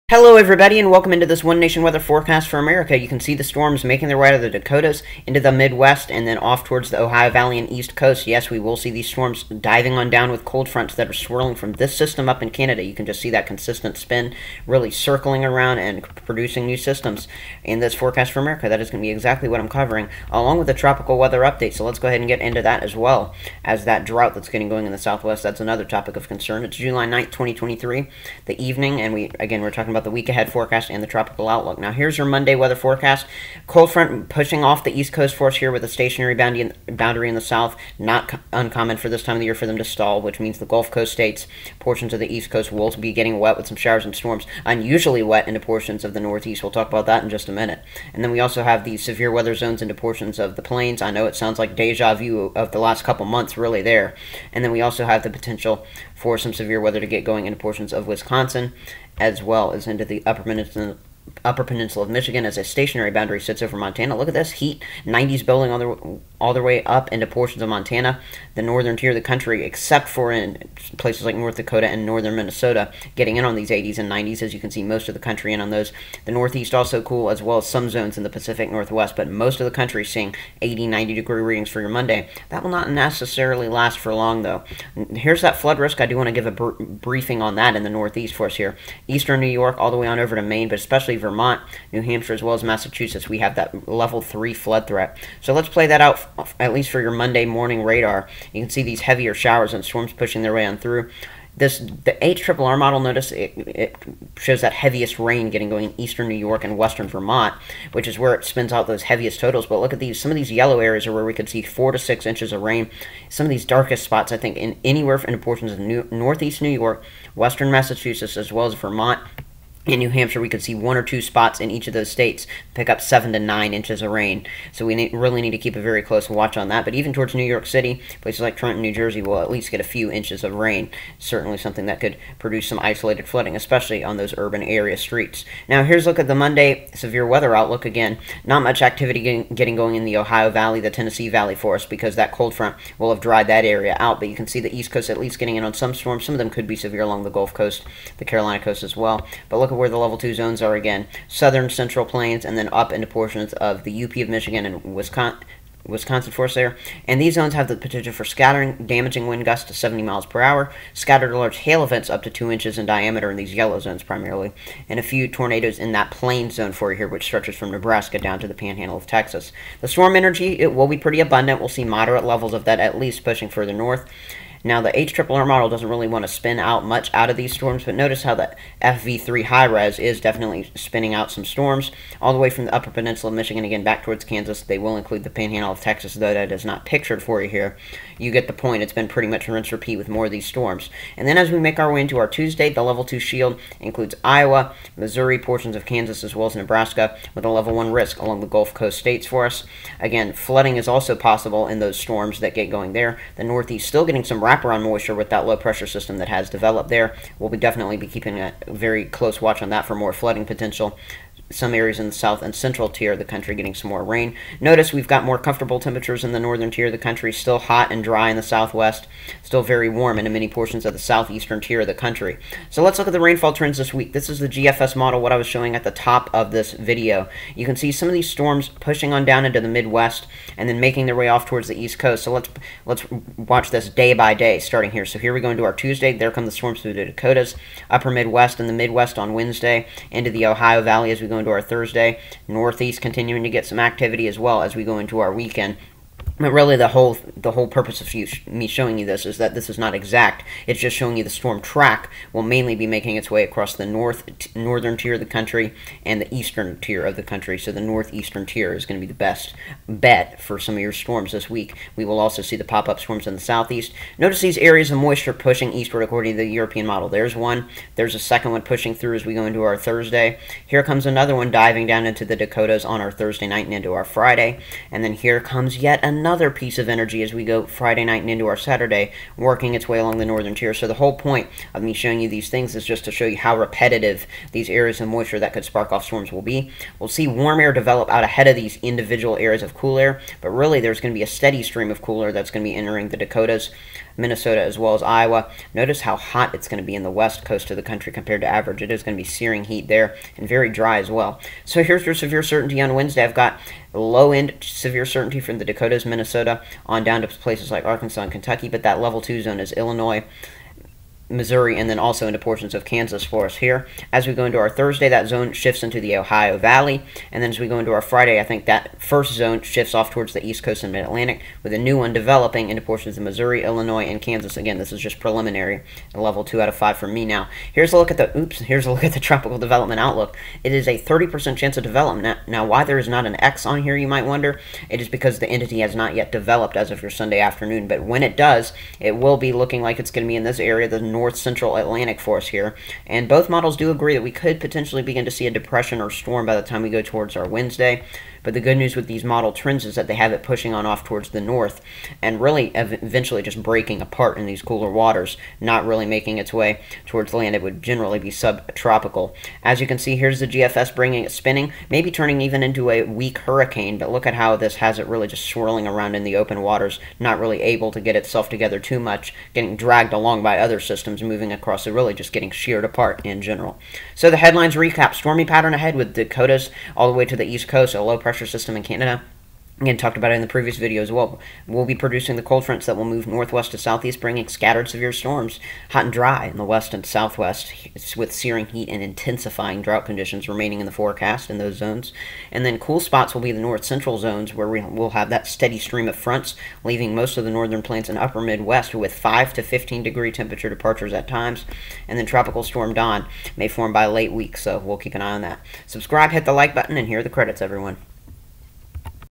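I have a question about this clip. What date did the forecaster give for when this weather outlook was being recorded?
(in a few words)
July 9th, 2023.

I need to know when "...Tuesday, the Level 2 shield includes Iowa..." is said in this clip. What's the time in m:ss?
3:12.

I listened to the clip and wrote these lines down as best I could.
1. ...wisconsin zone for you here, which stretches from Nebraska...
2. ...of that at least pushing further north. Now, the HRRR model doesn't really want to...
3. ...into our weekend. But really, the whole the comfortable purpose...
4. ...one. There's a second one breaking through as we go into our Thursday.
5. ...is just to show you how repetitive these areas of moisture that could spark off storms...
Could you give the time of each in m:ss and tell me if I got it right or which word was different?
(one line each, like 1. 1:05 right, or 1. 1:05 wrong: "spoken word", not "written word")
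1. 2:46 wrong: "plain", not "wisconsin"
2. 2:52 right
3. 4:04 wrong: "whole", not "comfortable"
4. 4:27 wrong: "pushing", not "breaking"
5. 4:42 right.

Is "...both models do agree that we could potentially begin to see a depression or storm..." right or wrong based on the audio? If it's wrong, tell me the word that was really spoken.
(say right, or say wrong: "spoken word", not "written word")
right.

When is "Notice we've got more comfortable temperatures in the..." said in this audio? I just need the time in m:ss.
3:34.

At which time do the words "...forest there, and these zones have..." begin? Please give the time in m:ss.
2:36.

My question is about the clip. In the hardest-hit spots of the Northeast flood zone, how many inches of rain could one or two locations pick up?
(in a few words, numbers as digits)
7 to 9 inches.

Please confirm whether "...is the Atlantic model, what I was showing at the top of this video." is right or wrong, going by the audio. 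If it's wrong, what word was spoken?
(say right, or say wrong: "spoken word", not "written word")
wrong: "GFS", not "Atlantic".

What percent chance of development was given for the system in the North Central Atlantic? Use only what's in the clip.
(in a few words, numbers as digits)
30%.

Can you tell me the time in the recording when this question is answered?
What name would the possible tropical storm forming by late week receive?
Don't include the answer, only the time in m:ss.
6:42.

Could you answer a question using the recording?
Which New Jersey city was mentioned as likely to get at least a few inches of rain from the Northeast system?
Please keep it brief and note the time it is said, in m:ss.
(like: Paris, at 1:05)
Trenton, at 2:08.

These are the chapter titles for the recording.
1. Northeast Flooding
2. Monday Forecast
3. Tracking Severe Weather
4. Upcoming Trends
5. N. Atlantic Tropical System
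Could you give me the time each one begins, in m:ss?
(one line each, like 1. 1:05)
1. 1:23
2. 0:30
3. 2:10
4. 3:41
5. 5:25.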